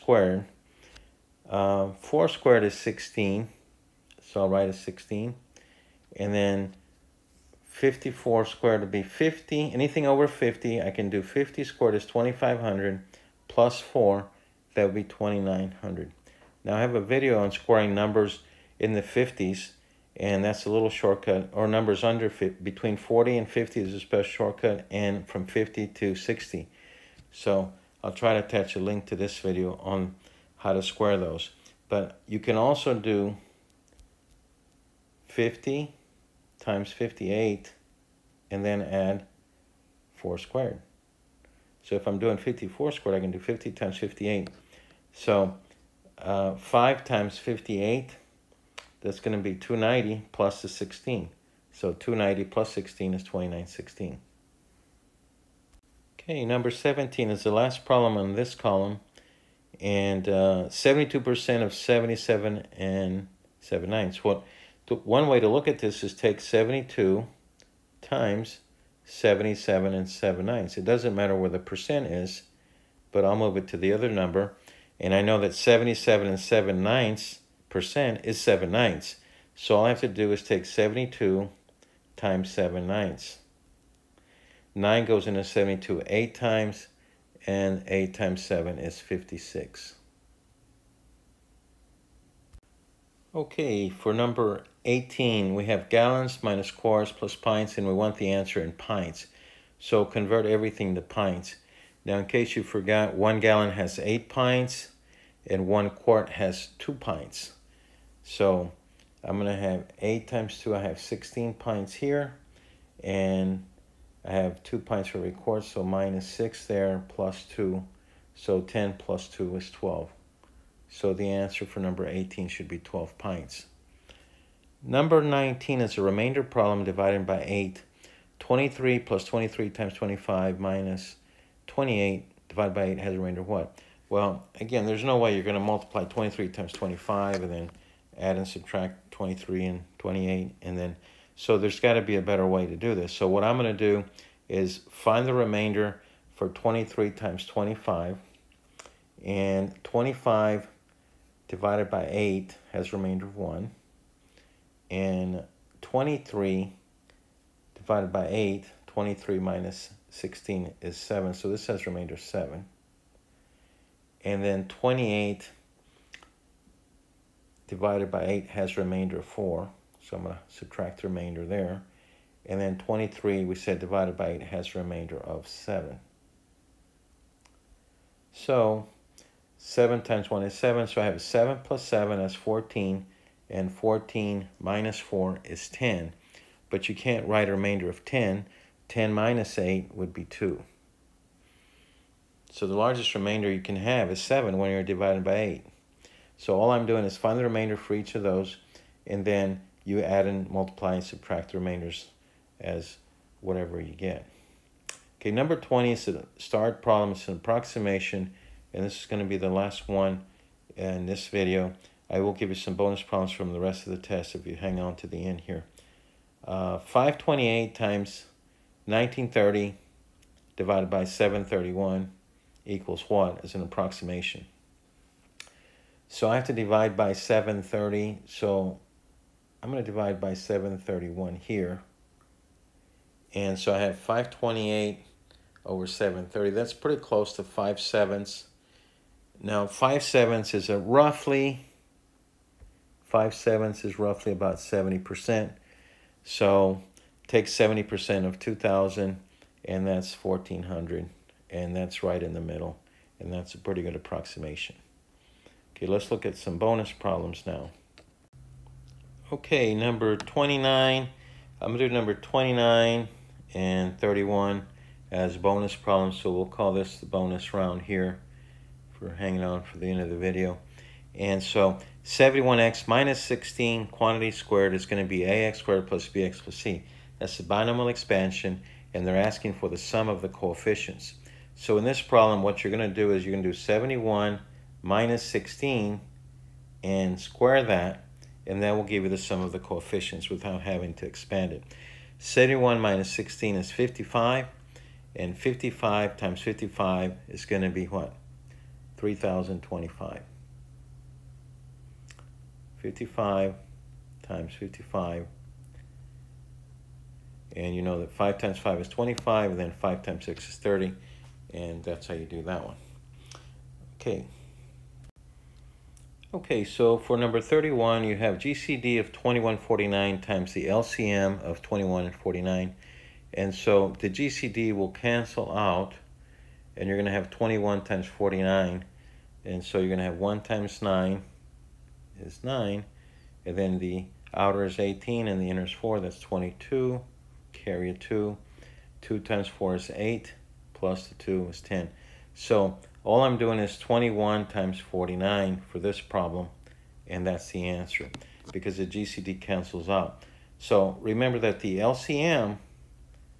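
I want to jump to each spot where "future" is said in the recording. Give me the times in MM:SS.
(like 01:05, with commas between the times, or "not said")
not said.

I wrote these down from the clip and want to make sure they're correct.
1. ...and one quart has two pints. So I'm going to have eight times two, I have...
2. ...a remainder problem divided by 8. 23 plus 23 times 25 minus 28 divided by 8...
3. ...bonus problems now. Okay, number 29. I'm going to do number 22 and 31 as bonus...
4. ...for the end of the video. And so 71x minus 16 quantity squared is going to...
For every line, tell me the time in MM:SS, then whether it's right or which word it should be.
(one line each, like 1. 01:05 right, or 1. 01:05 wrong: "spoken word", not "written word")
1. 01:45 right
2. 02:05 right
3. 04:16 wrong: "29", not "22"
4. 04:29 right.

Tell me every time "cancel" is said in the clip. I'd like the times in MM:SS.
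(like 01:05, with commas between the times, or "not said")
05:24, 05:49.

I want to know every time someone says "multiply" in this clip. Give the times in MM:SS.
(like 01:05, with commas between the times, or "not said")
02:15, 03:20.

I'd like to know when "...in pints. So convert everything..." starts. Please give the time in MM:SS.
01:38.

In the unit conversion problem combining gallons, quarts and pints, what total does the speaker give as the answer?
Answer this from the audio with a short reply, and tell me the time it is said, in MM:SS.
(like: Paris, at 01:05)
12 pints, at 02:02.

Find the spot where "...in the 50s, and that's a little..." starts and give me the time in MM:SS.
00:18.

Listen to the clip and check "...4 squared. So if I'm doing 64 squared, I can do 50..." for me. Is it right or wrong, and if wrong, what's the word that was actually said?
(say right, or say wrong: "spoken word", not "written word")
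wrong: "54", not "64".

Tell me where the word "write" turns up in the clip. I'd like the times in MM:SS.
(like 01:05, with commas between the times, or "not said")
00:04, 03:07.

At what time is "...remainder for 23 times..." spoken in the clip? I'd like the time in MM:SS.
02:25.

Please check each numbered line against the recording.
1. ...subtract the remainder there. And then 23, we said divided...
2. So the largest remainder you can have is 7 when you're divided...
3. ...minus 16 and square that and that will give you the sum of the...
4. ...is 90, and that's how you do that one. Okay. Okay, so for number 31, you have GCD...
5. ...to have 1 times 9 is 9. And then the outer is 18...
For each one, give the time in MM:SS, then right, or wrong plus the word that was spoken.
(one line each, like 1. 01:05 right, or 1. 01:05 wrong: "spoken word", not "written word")
1. 02:50 right
2. 03:12 right
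3. 04:44 right
4. 05:10 wrong: "30", not "90"
5. 05:30 right.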